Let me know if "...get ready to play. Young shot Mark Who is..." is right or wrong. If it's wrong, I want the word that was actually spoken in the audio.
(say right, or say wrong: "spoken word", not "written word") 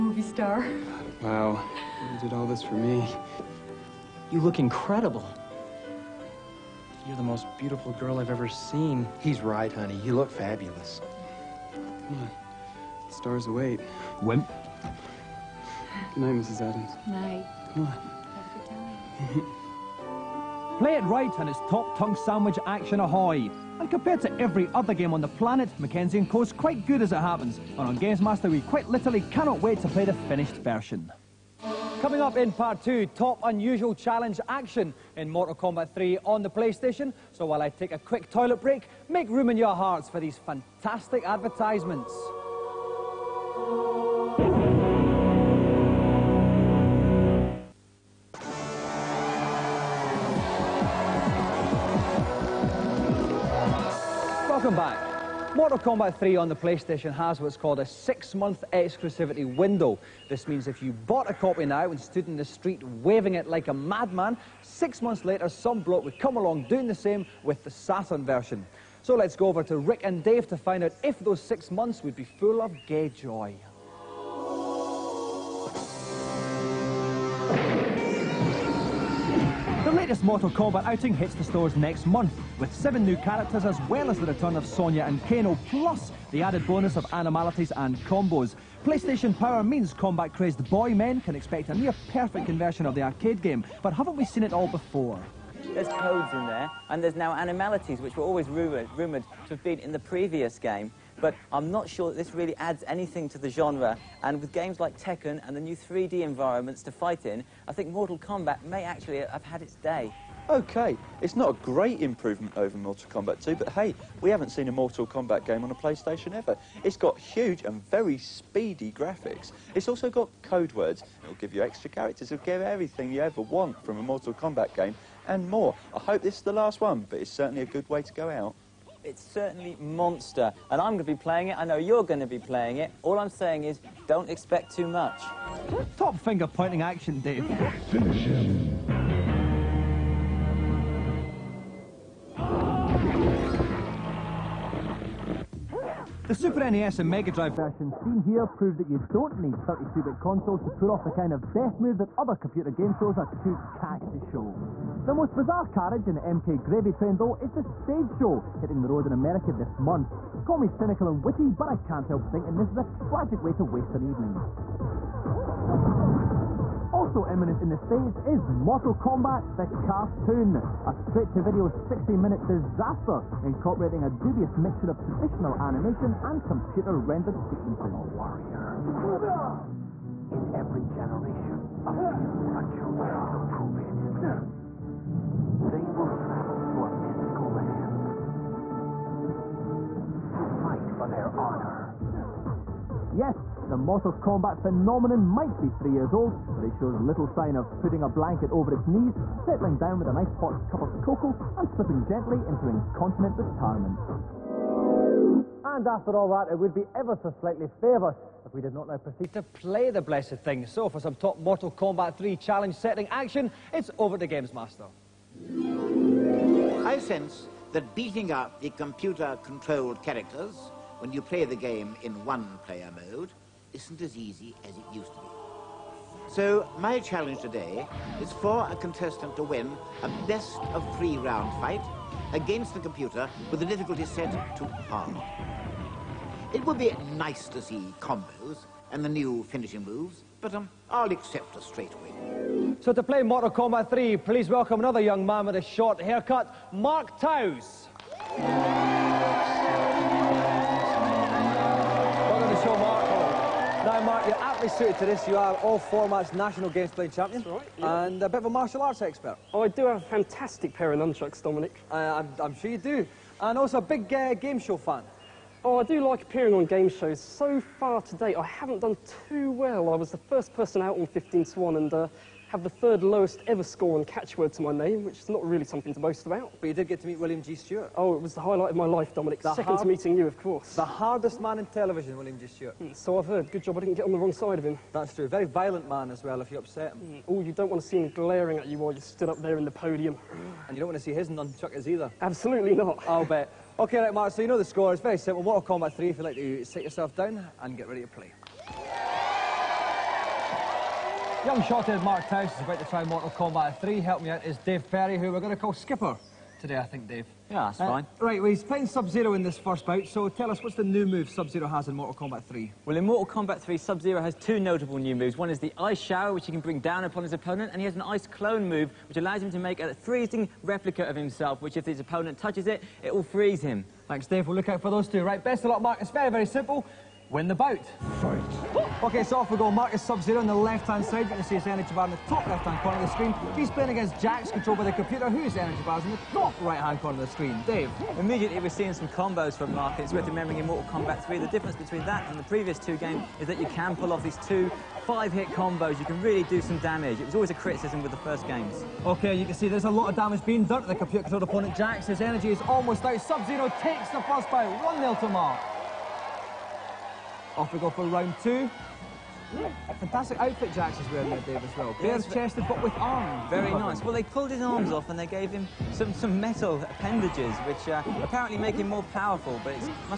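wrong: "Tyson", not "Who".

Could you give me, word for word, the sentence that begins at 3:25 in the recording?
And after all that, it would be ever so slightly favous if we did not now proceed to play the blessed thing.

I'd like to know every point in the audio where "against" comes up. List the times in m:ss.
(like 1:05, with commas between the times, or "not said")
3:52, 5:33.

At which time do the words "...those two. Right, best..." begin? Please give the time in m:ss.
5:24.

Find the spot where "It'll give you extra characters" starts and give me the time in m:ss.
2:01.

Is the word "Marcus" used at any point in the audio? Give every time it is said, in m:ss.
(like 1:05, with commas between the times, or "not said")
5:29, 5:39.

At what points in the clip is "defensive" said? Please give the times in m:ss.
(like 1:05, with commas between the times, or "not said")
not said.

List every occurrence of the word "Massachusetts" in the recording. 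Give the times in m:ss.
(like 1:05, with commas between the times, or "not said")
not said.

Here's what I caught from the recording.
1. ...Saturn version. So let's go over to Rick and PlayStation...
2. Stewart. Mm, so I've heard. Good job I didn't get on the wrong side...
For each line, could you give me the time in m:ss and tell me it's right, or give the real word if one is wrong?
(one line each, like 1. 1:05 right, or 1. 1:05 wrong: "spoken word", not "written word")
1. 1:07 wrong: "Dave", not "PlayStation"
2. 4:42 right.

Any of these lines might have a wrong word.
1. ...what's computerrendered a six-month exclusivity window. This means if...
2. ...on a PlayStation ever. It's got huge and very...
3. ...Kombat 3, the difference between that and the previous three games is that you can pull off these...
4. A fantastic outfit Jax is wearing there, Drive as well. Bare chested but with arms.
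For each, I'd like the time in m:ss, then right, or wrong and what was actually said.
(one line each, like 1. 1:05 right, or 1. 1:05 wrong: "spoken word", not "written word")
1. 0:57 wrong: "called", not "computerrendered"
2. 1:55 right
3. 5:40 wrong: "two", not "three"
4. 5:59 wrong: "Dave", not "Drive".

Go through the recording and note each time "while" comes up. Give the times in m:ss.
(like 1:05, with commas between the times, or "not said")
0:37, 4:48.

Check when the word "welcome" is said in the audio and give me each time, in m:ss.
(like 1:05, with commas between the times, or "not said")
4:04.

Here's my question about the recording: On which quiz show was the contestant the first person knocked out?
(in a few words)
15 to 1.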